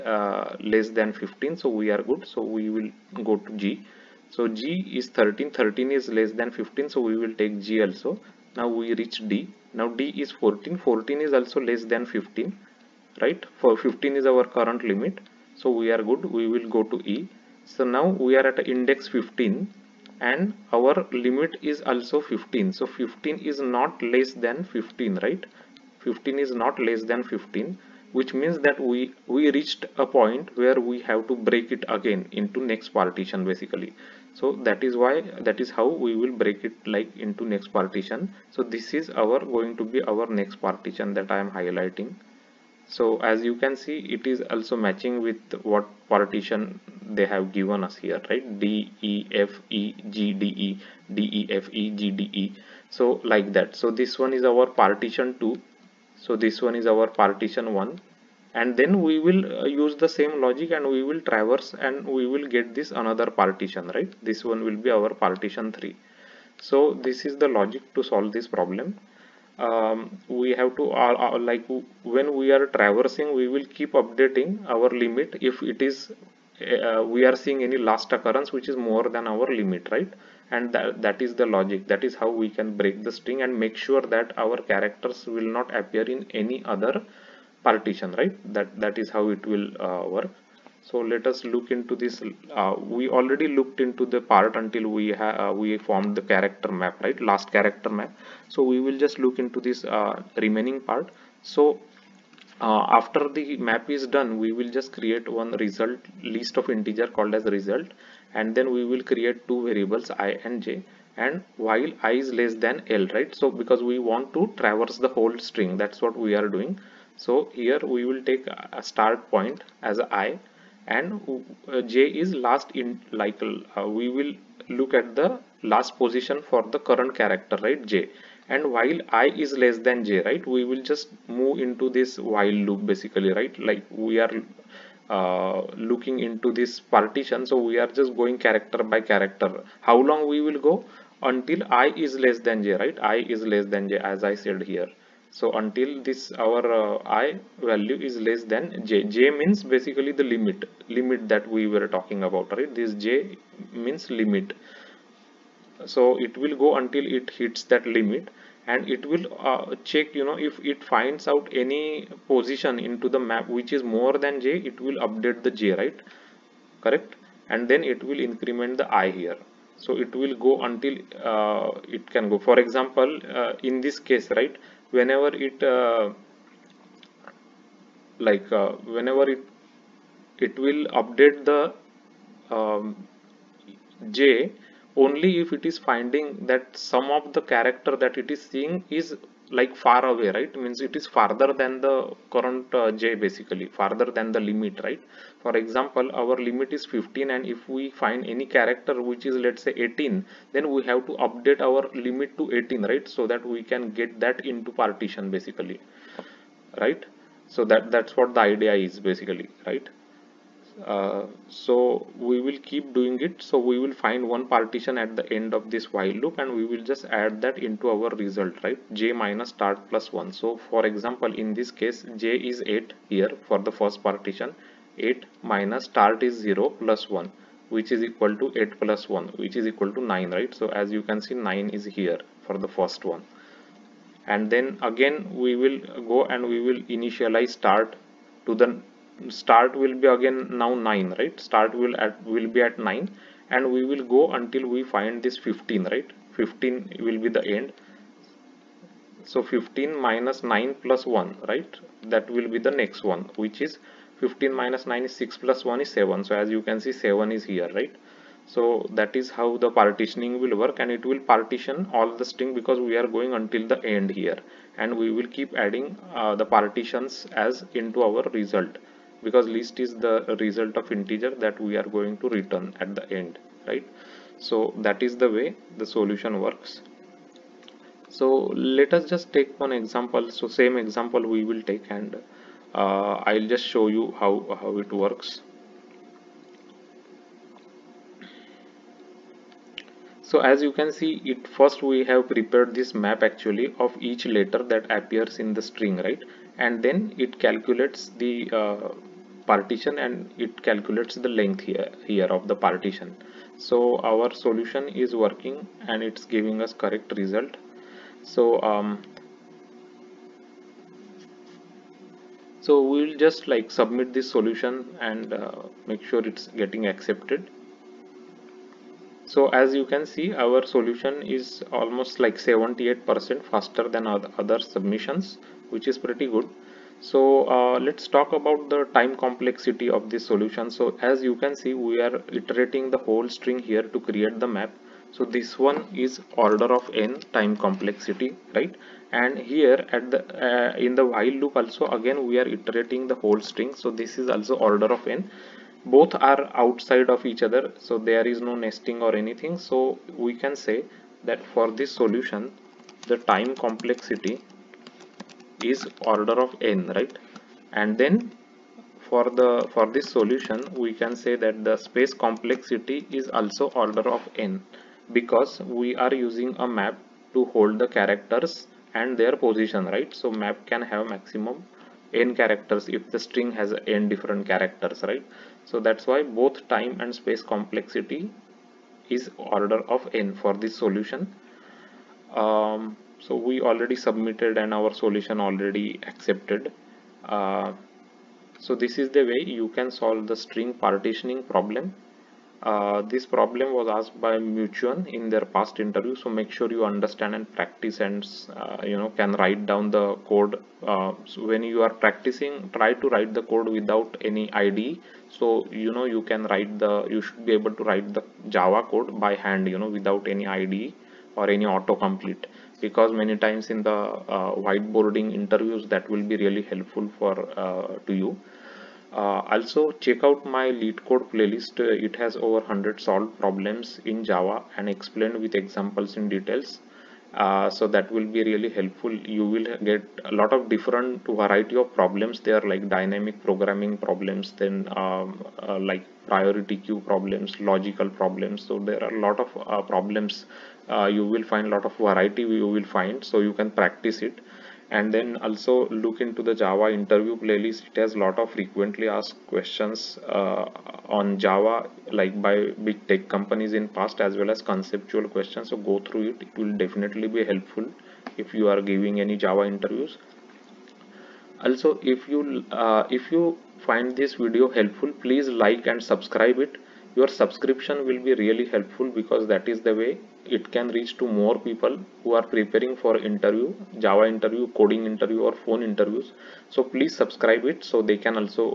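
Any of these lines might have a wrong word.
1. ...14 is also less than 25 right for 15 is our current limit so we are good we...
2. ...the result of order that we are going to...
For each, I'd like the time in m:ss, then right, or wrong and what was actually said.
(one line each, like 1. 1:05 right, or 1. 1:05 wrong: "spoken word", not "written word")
1. 0:10 wrong: "15", not "25"
2. 4:29 wrong: "integer", not "order".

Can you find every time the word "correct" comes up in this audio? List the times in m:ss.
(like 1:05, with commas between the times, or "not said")
2:46, 5:06.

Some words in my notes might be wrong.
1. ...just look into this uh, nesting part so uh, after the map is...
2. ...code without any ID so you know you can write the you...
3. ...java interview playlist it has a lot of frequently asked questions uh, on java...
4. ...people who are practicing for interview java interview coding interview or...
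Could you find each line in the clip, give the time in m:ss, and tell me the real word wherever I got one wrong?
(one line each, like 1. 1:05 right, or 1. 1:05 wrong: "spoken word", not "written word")
1. 1:38 wrong: "remaining", not "nesting"
2. 6:43 right
3. 7:26 right
4. 7:51 wrong: "preparing", not "practicing".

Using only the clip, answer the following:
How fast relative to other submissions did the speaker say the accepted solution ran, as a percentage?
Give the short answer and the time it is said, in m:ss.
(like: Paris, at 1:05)
78%, at 5:22.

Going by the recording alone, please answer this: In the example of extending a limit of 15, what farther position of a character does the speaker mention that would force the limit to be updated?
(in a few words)
18.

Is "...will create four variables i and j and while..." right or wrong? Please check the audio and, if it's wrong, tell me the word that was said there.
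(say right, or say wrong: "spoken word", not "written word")
wrong: "two", not "four".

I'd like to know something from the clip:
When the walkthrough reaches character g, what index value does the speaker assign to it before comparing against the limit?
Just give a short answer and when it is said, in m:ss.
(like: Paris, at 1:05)
13, at 0:04.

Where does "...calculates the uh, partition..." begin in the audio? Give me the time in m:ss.
4:57.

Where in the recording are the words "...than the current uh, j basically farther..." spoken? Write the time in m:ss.
3:11.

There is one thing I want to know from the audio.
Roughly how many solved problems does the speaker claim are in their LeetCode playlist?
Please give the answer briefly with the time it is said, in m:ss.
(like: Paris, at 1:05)
over 100, at 7:02.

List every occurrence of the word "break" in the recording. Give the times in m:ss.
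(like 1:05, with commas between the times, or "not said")
0:31, 0:36, 1:22.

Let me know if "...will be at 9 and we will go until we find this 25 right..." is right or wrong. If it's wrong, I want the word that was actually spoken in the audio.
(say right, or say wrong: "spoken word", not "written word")
wrong: "15", not "25".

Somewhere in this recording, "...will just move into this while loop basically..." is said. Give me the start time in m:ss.
2:10.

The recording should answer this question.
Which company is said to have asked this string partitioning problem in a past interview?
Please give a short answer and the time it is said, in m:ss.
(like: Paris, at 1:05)
Meituan, at 6:34.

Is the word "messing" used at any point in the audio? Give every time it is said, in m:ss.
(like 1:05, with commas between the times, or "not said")
not said.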